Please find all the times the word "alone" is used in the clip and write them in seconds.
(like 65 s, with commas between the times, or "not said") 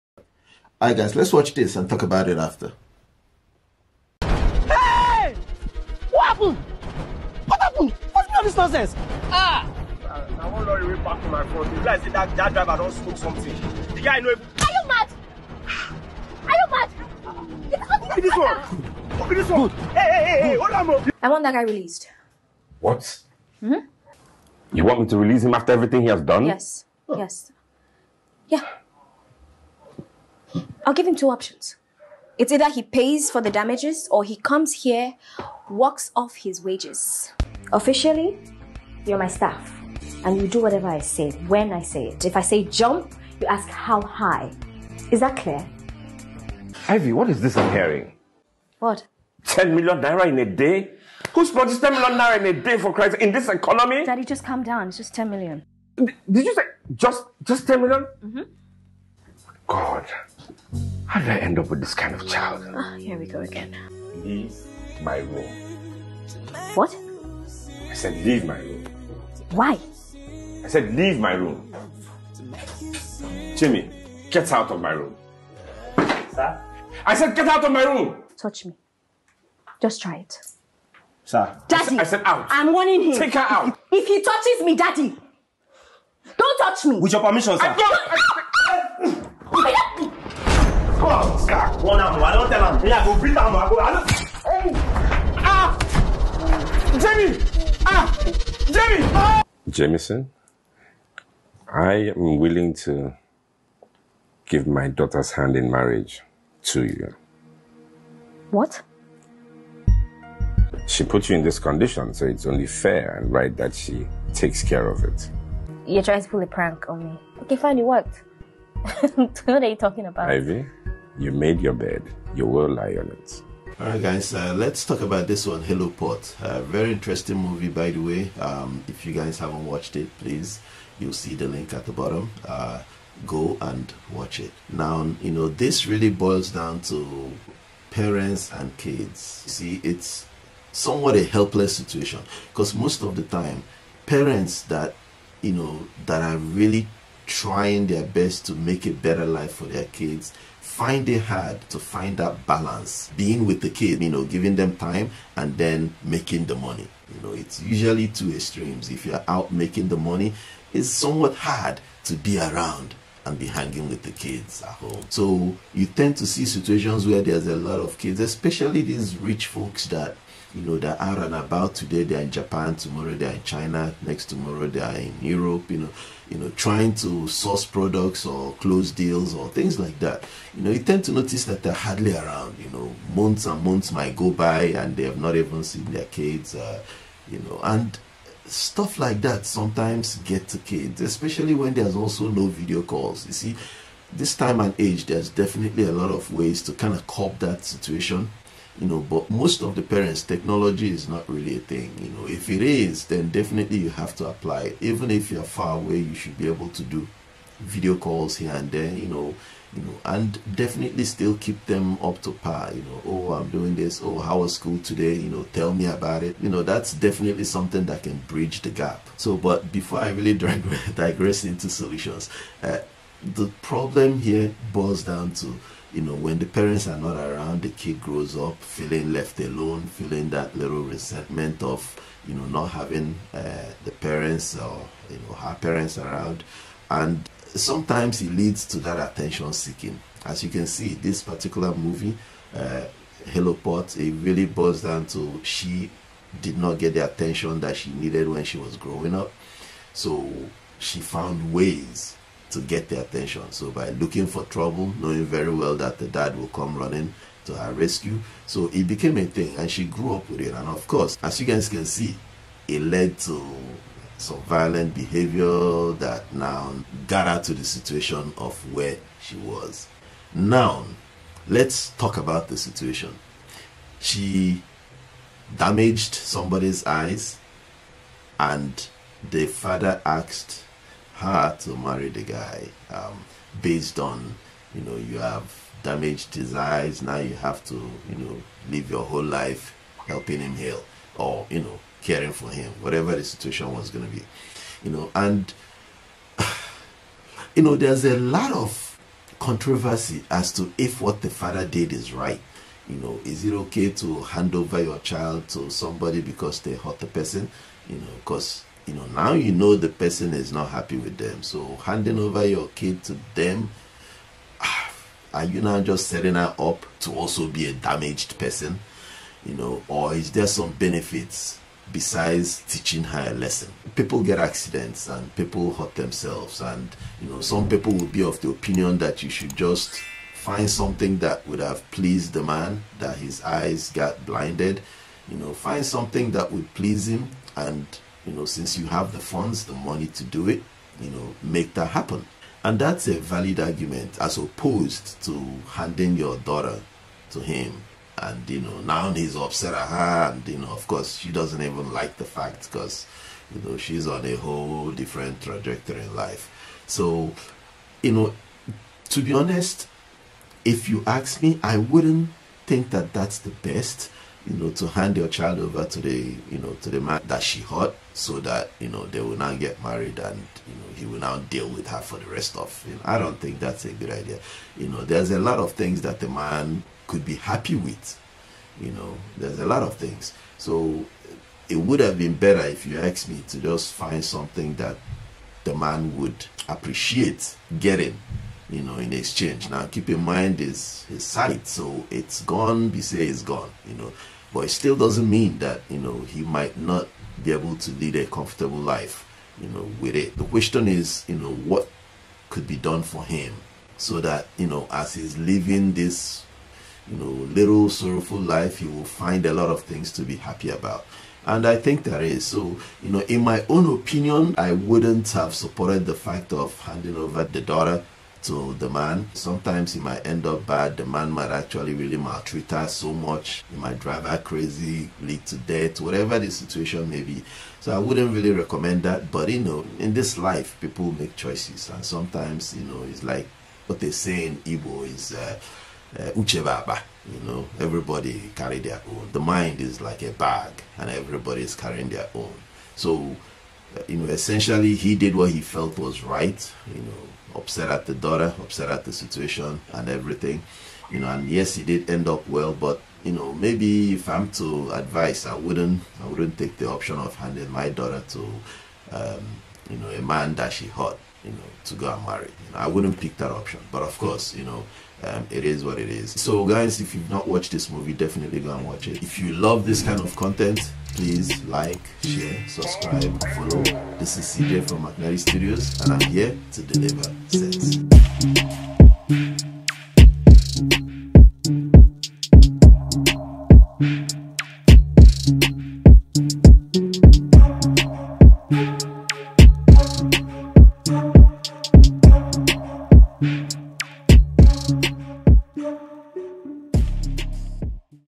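229 s.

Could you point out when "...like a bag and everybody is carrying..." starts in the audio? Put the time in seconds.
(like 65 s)
440 s.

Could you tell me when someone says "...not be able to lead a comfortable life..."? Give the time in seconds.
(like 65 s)
396 s.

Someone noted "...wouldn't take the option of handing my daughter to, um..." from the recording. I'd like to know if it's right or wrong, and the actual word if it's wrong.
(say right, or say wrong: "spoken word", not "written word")
right.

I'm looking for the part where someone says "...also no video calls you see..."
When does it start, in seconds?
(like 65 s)
191 s.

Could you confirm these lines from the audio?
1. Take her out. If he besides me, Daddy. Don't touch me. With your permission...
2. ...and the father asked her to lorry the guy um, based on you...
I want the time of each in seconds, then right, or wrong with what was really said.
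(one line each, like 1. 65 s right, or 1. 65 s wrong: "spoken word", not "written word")
1. 83 s wrong: "touches", not "besides"
2. 278 s wrong: "marry", not "lorry".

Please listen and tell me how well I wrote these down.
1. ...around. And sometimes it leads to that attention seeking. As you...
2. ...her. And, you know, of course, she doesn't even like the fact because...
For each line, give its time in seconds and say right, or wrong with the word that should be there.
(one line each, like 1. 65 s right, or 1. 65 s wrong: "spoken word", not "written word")
1. 235 s right
2. 349 s right.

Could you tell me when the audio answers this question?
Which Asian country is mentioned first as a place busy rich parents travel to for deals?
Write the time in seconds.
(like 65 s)
172 s.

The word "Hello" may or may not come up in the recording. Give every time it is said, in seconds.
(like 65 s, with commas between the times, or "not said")
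125 s, 243 s.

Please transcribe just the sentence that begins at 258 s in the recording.
So it became a thing and she grew up with it.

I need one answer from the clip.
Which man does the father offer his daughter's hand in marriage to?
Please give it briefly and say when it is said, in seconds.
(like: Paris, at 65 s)
Jamison, at 99 s.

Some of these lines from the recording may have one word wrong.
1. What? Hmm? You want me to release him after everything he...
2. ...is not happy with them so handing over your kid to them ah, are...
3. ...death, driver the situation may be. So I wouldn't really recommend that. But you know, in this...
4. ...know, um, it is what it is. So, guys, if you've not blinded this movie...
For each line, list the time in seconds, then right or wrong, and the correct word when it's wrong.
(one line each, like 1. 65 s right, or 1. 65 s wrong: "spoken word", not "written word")
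1. 22 s right
2. 310 s right
3. 425 s wrong: "whatever", not "driver"
4. 464 s wrong: "watched", not "blinded".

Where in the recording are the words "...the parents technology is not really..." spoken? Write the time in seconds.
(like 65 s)
199 s.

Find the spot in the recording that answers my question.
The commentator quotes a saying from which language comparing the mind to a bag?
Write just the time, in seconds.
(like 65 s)
434 s.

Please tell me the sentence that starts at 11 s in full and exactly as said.
You guys see that, that driver don't smoke something.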